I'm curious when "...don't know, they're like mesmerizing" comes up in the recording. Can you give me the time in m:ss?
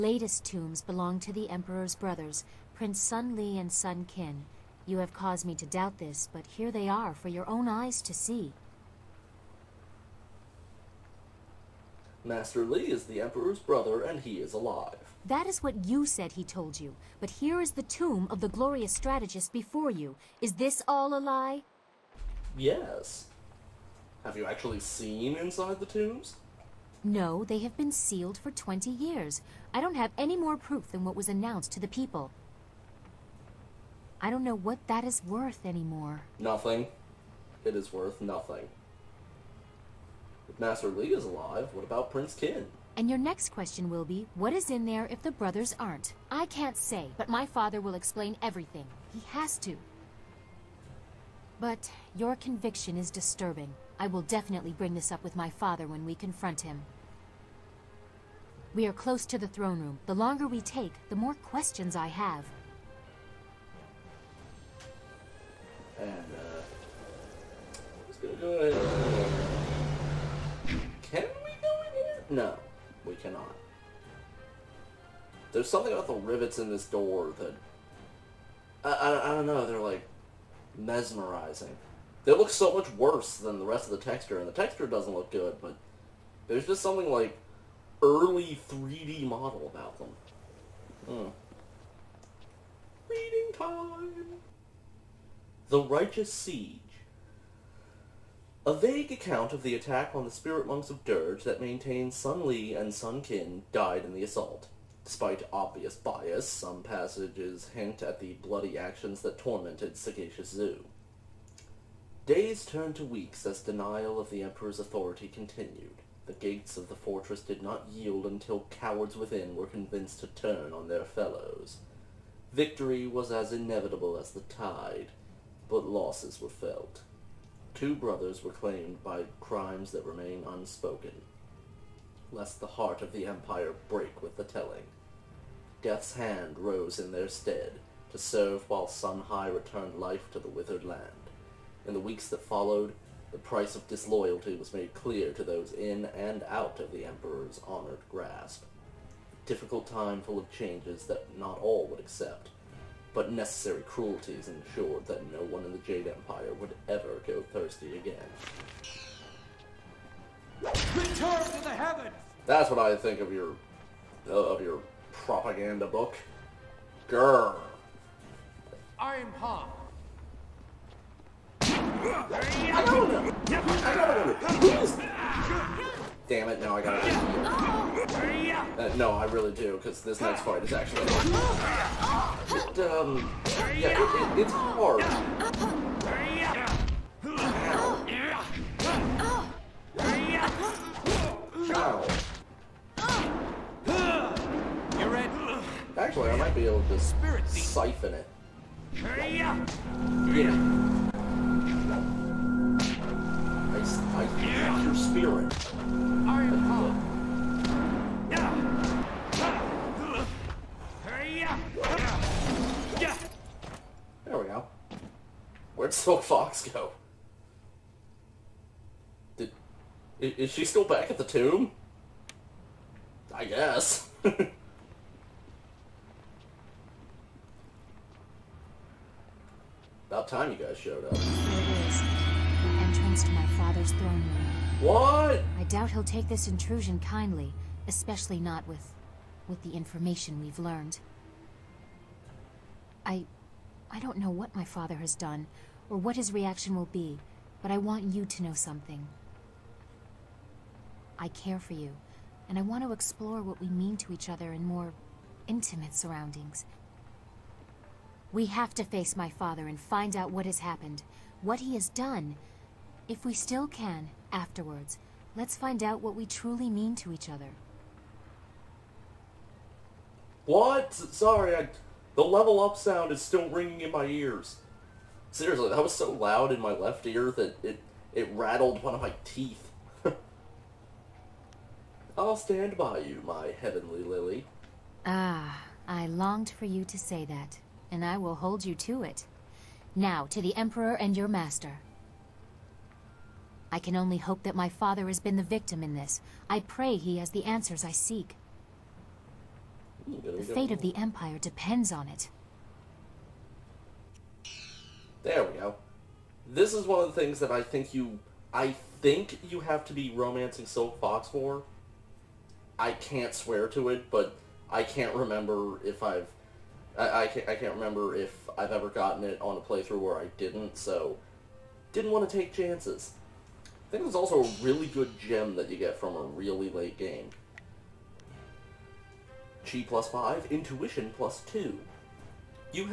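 1:19.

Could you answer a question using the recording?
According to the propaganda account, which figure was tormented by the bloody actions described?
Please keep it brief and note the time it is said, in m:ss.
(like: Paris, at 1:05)
Sagacious Zu, at 1:49.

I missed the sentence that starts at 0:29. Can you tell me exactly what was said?
I don't have any more proof than what was announced to the people.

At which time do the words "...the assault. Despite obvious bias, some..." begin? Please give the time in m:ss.
1:44.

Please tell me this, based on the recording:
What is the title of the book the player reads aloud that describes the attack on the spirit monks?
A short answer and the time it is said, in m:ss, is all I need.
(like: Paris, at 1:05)
The Righteous Siege, at 1:35.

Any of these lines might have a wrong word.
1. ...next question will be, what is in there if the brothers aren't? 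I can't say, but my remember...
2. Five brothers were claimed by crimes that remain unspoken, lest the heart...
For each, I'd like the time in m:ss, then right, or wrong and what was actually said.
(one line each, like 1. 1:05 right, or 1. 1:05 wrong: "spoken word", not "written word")
1. 0:43 wrong: "father", not "remember"
2. 2:07 wrong: "Two", not "Five".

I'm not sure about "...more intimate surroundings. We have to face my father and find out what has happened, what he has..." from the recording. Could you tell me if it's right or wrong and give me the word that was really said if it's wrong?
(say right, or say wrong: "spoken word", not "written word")
right.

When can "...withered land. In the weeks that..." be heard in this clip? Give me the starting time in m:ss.
2:20.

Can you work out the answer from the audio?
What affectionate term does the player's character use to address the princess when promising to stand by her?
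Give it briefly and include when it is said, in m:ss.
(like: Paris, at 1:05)
my heavenly lily, at 4:43.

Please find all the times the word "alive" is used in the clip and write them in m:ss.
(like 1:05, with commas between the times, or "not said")
0:14, 0:41.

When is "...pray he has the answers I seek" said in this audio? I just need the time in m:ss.
4:56.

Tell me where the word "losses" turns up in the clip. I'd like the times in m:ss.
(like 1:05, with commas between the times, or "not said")
2:05.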